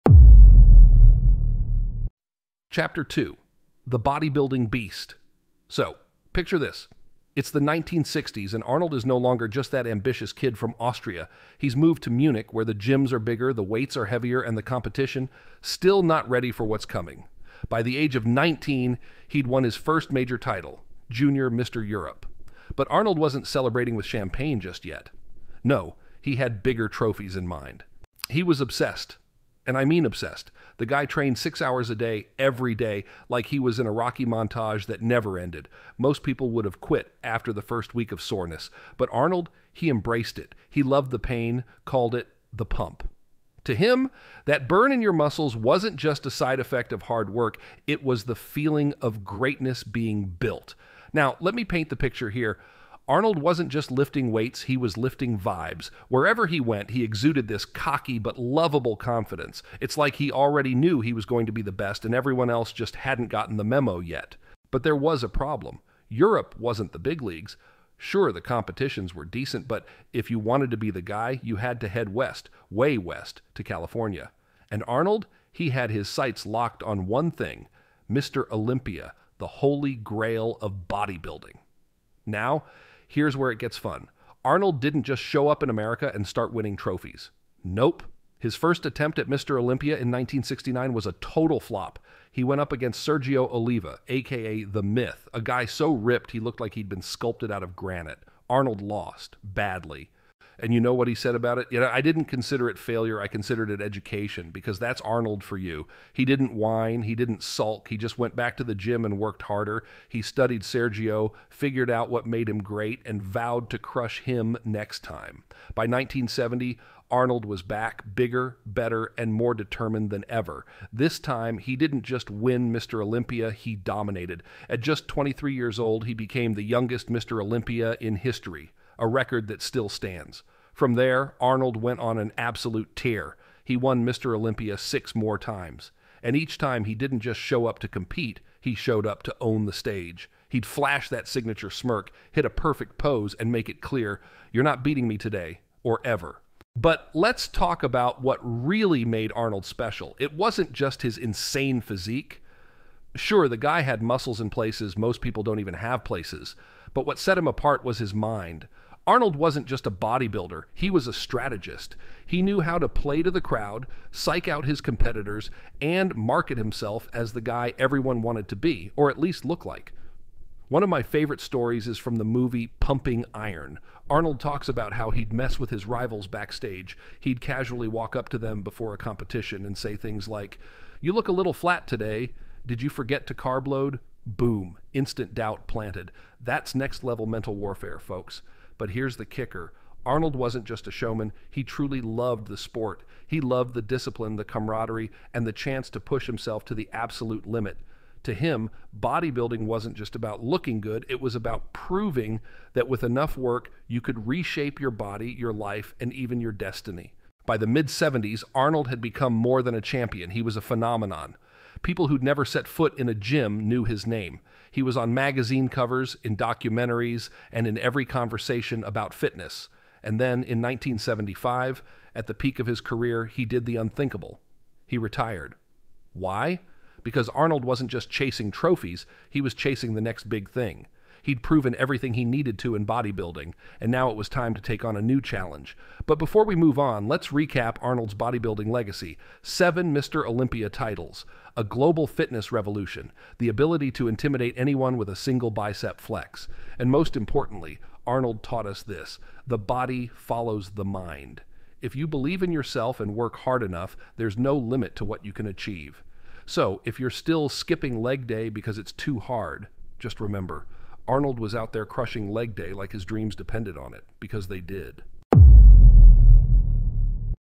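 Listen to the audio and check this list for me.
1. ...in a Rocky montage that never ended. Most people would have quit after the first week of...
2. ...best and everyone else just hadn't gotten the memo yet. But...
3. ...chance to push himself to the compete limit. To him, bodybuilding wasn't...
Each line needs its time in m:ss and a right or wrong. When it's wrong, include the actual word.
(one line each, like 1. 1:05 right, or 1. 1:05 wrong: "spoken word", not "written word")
1. 0:33 right
2. 1:01 right
3. 3:15 wrong: "absolute", not "compete".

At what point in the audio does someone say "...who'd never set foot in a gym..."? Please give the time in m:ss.
3:32.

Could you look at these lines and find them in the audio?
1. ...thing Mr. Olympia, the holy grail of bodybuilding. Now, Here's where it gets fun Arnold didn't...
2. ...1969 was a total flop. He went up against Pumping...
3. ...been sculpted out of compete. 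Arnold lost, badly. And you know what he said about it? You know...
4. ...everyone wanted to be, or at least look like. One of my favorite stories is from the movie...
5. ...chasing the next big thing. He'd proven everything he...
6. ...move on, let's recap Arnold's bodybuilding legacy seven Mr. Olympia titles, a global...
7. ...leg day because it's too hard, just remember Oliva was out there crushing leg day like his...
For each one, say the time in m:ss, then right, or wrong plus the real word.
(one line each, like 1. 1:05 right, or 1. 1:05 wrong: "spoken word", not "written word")
1. 1:17 right
2. 1:30 wrong: "Sergio", not "Pumping"
3. 1:36 wrong: "granite", not "compete"
4. 2:47 right
5. 3:49 right
6. 3:56 right
7. 4:18 wrong: "Arnold", not "Oliva".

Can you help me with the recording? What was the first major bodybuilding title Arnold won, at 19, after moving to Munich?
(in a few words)
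Junior Mr. Europe.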